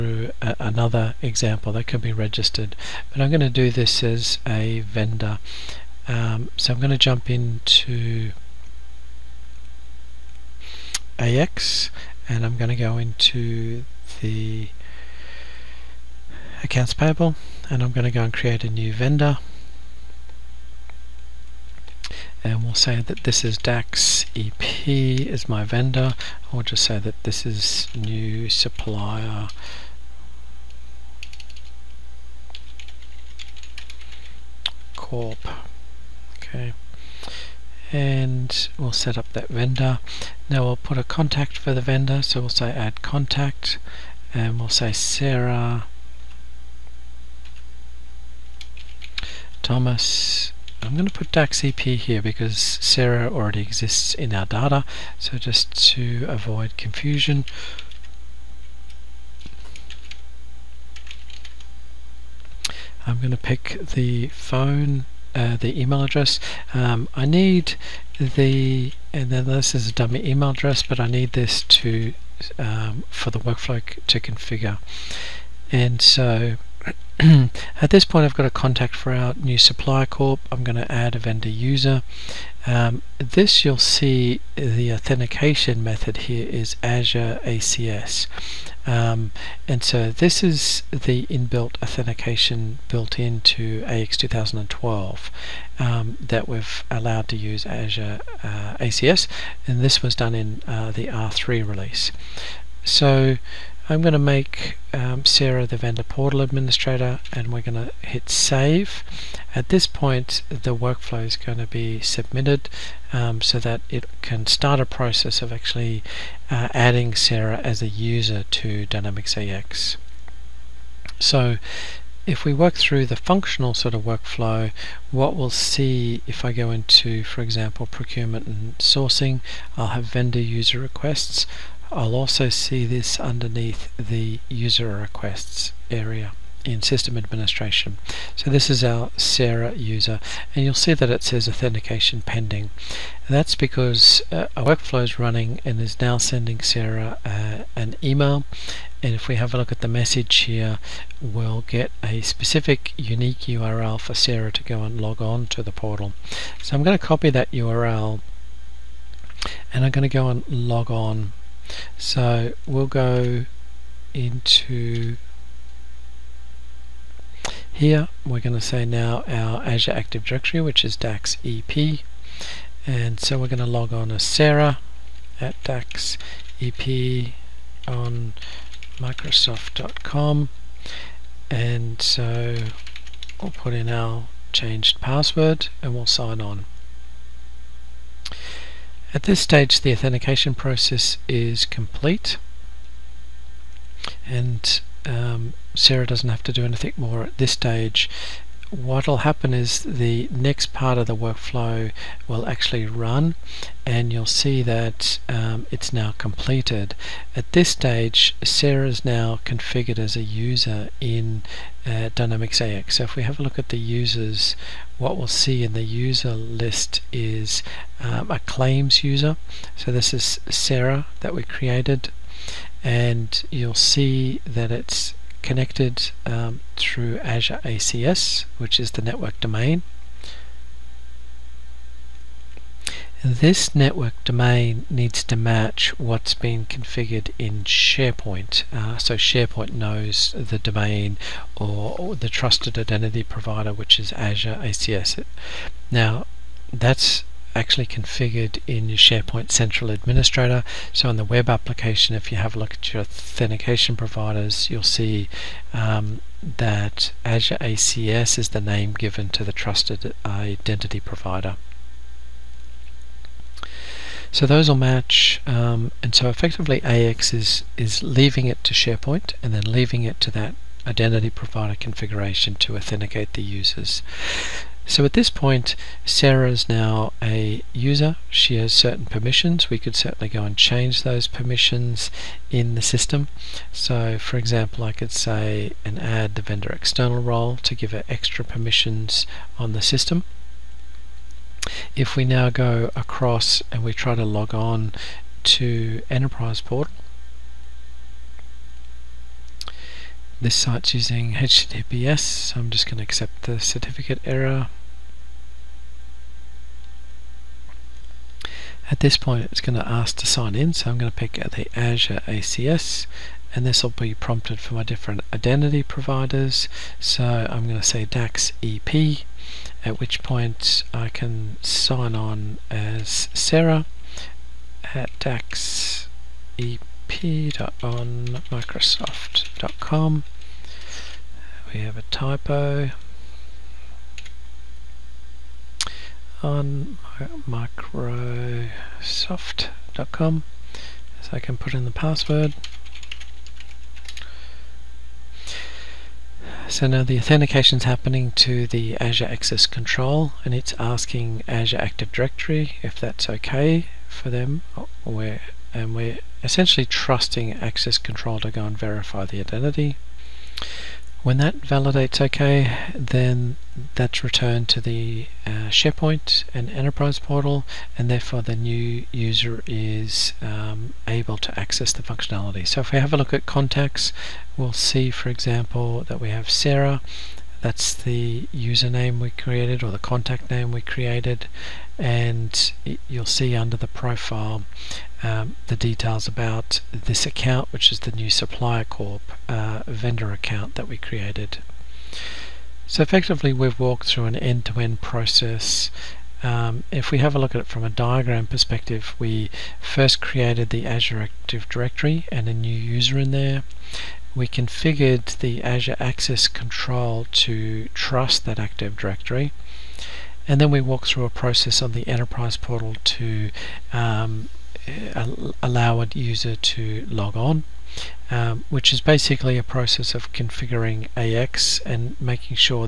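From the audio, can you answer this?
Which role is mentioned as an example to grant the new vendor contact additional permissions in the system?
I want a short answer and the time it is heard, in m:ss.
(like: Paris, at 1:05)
vendor external, at 4:46.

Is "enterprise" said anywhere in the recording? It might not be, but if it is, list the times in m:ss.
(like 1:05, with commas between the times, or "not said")
4:56, 6:06, 6:52.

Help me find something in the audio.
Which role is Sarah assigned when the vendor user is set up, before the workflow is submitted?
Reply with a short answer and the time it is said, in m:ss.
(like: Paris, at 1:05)
vendor portal administrator, at 1:45.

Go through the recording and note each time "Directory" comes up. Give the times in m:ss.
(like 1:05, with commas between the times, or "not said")
2:50, 5:52, 6:41, 6:48.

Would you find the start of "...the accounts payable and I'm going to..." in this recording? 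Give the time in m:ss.
0:14.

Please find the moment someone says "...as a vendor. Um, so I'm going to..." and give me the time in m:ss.
0:04.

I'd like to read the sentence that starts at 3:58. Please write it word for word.
Uh, so SharePoint knows the domain or, or, the trusted identity provider which is Azure ACS.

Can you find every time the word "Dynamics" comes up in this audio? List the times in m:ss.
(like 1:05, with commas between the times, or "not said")
1:58, 3:32.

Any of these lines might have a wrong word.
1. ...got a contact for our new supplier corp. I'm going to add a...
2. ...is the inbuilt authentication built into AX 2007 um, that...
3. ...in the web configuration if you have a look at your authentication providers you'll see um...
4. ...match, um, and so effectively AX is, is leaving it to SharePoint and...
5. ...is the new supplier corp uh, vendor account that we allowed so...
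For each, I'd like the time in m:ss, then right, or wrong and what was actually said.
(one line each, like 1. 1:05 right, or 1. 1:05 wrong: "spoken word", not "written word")
1. 1:18 right
2. 1:30 wrong: "2012", not "2007"
3. 4:11 wrong: "application", not "configuration"
4. 4:24 right
5. 6:27 wrong: "created", not "allowed".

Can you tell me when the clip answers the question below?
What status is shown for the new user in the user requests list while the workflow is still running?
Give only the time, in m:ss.
2:21.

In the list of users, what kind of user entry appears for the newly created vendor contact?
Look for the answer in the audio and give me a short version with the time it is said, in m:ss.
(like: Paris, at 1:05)
claims user, at 3:38.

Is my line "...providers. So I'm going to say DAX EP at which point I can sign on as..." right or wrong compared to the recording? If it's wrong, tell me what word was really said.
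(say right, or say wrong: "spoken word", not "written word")
right.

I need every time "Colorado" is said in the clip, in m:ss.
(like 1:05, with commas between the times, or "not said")
not said.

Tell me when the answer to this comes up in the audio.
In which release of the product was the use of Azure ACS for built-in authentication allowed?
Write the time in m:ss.
1:41.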